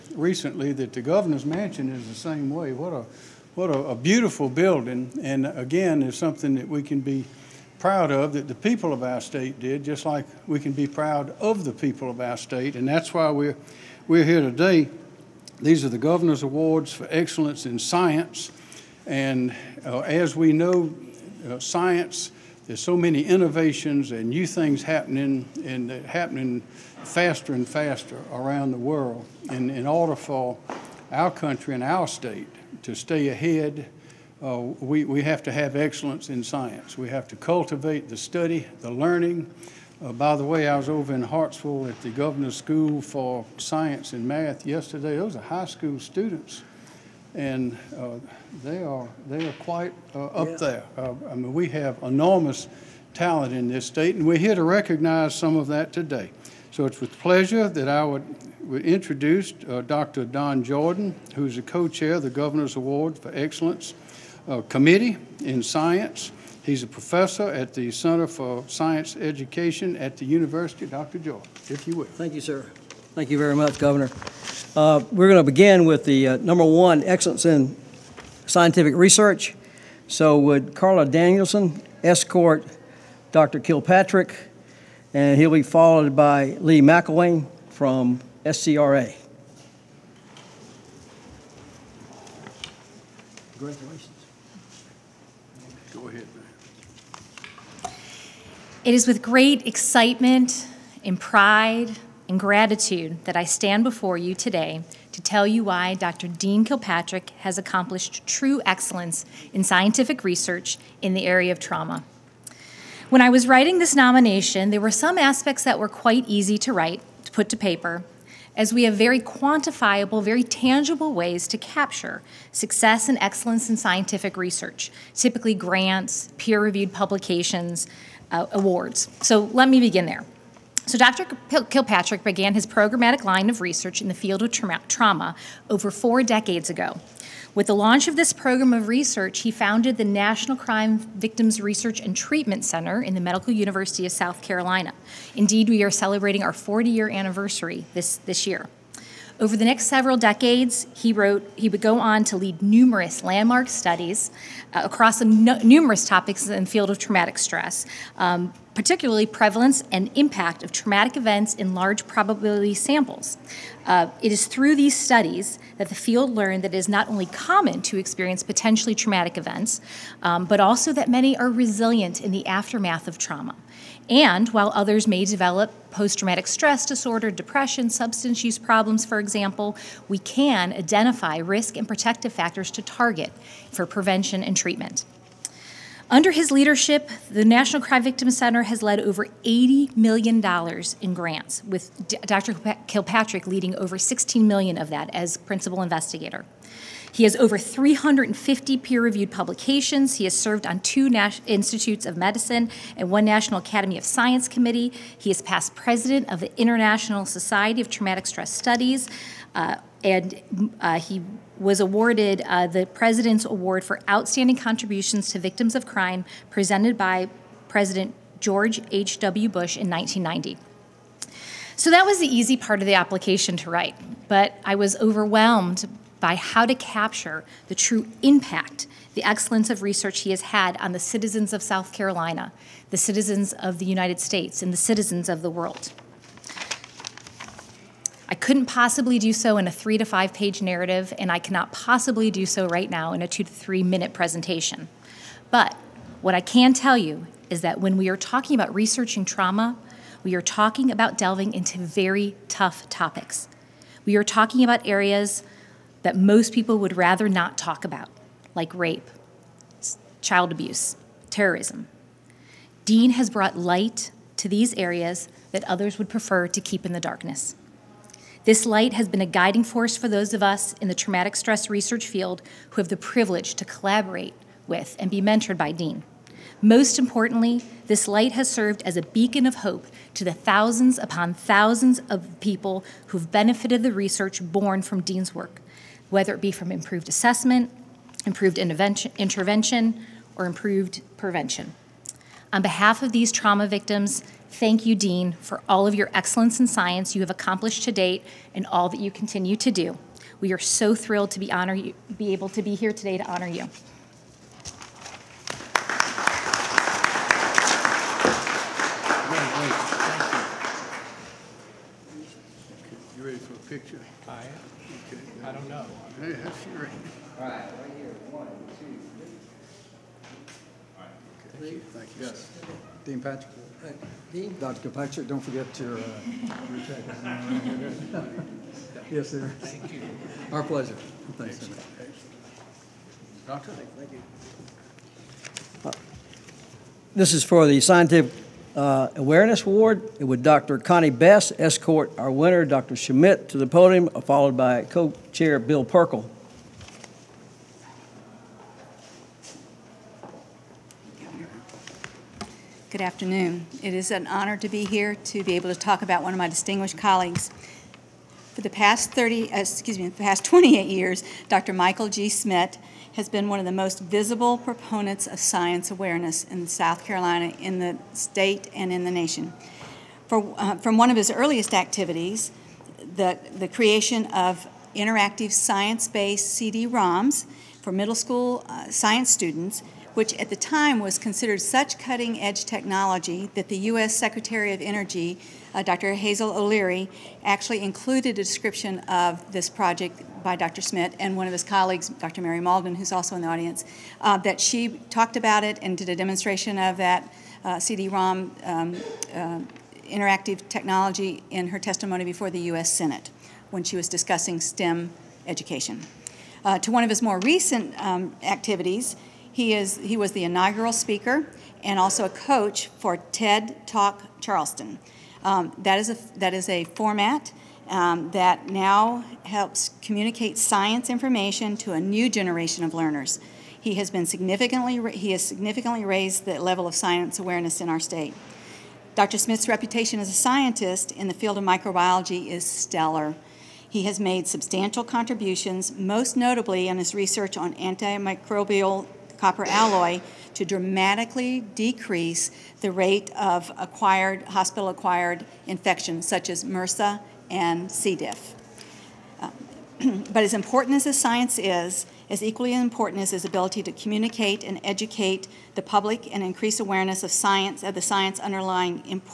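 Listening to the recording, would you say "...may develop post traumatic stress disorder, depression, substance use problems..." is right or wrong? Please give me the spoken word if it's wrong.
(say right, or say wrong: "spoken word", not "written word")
right.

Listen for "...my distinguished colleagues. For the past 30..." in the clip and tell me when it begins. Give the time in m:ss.
5:56.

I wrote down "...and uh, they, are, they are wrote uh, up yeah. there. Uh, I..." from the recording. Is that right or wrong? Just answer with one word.
wrong.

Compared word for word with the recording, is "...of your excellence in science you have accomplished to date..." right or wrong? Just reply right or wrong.
right.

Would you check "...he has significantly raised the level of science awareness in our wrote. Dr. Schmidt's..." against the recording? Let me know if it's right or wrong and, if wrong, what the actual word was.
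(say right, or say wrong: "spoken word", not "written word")
wrong: "state", not "wrote".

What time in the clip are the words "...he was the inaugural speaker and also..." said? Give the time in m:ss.
6:50.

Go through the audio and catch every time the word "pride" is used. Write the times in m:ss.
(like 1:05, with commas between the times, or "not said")
1:41.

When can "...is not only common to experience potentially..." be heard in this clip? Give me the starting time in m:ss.
2:46.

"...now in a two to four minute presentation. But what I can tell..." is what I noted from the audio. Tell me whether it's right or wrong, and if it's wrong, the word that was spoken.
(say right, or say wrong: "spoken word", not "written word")
wrong: "three", not "four".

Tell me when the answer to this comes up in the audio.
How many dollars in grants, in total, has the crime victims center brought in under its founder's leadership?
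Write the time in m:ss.
3:09.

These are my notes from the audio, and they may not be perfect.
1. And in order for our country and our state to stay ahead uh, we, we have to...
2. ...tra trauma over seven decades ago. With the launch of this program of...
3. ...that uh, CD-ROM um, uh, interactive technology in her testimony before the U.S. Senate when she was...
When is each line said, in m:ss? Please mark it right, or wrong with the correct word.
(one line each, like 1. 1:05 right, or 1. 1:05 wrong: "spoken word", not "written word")
1. 0:29 right
2. 2:14 wrong: "four", not "seven"
3. 6:36 right.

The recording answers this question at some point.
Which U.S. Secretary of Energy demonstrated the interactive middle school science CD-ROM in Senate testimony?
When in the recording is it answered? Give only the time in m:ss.
6:26.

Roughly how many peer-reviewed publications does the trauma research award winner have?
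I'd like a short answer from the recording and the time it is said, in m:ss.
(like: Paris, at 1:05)
350, at 3:17.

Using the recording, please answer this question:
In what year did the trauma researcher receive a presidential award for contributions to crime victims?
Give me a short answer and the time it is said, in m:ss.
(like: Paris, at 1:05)
1990, at 3:39.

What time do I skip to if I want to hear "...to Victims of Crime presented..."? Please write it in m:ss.
3:35.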